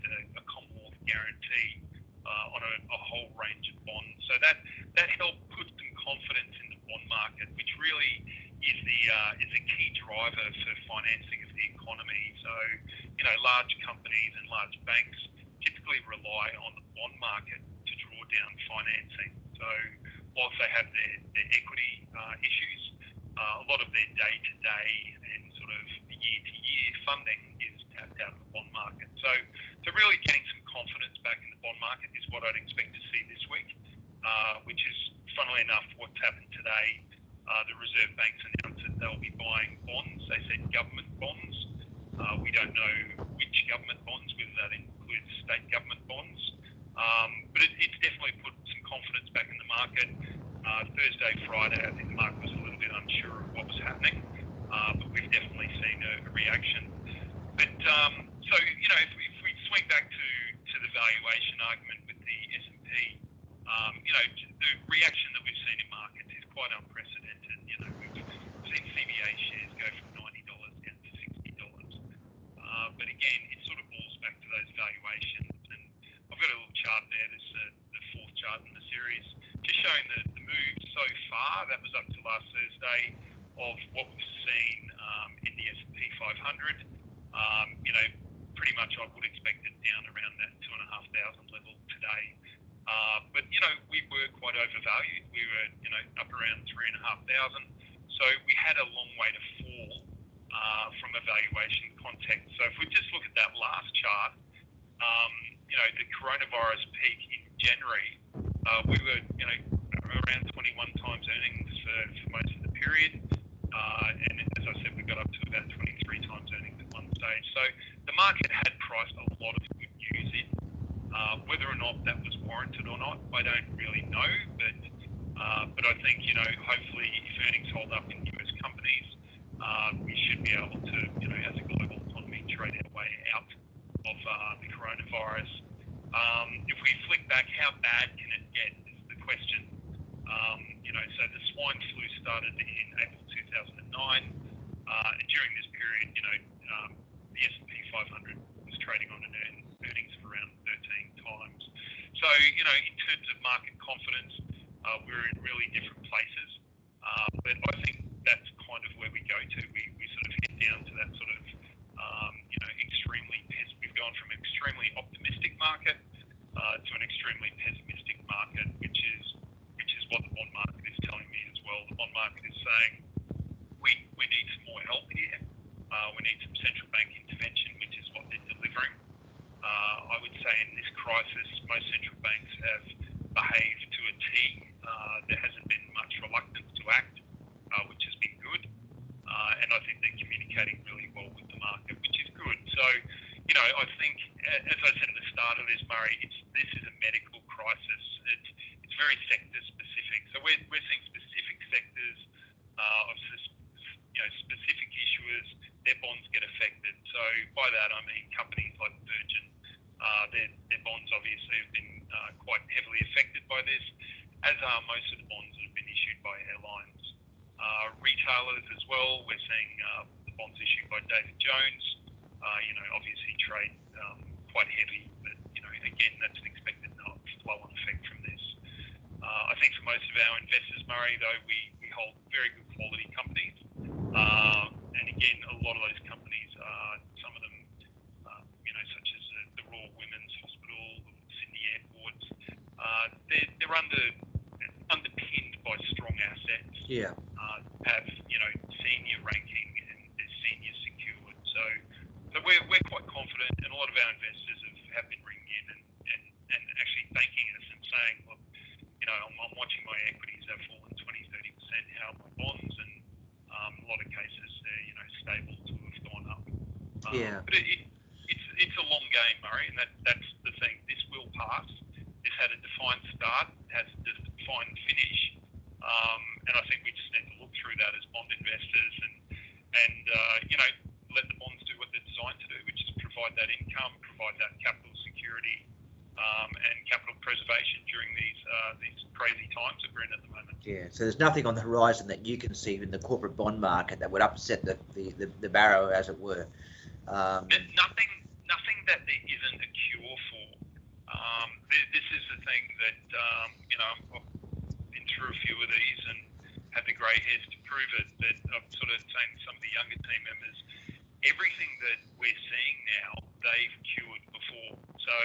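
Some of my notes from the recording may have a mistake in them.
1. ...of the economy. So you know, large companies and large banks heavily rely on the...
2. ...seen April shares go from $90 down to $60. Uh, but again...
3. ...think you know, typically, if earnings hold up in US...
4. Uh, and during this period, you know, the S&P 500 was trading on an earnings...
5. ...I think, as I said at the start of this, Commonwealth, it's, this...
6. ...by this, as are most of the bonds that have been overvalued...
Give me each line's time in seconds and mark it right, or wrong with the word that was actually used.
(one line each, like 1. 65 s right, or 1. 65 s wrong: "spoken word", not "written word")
1. 11 s wrong: "typically", not "heavily"
2. 68 s wrong: "CBA", not "April"
3. 125 s wrong: "hopefully", not "typically"
4. 143 s right
5. 193 s wrong: "Murray", not "Commonwealth"
6. 213 s wrong: "issued", not "overvalued".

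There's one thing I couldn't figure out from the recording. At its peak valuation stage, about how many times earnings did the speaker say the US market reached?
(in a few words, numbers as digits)
23.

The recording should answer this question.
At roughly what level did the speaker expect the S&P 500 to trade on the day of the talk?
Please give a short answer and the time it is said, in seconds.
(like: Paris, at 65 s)
2,500, at 90 s.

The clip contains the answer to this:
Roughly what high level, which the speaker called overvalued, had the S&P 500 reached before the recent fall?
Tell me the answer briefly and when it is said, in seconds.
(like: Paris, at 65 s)
3,500, at 96 s.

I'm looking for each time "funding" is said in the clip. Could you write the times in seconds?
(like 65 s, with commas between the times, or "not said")
27 s.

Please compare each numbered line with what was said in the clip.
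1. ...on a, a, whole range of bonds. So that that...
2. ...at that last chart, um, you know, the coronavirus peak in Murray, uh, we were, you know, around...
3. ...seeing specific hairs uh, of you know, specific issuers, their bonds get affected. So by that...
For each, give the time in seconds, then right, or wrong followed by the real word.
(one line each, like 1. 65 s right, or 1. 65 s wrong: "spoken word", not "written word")
1. 2 s right
2. 103 s wrong: "January", not "Murray"
3. 200 s wrong: "sectors", not "hairs".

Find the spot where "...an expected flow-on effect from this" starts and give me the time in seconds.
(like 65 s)
226 s.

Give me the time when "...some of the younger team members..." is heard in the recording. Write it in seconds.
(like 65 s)
309 s.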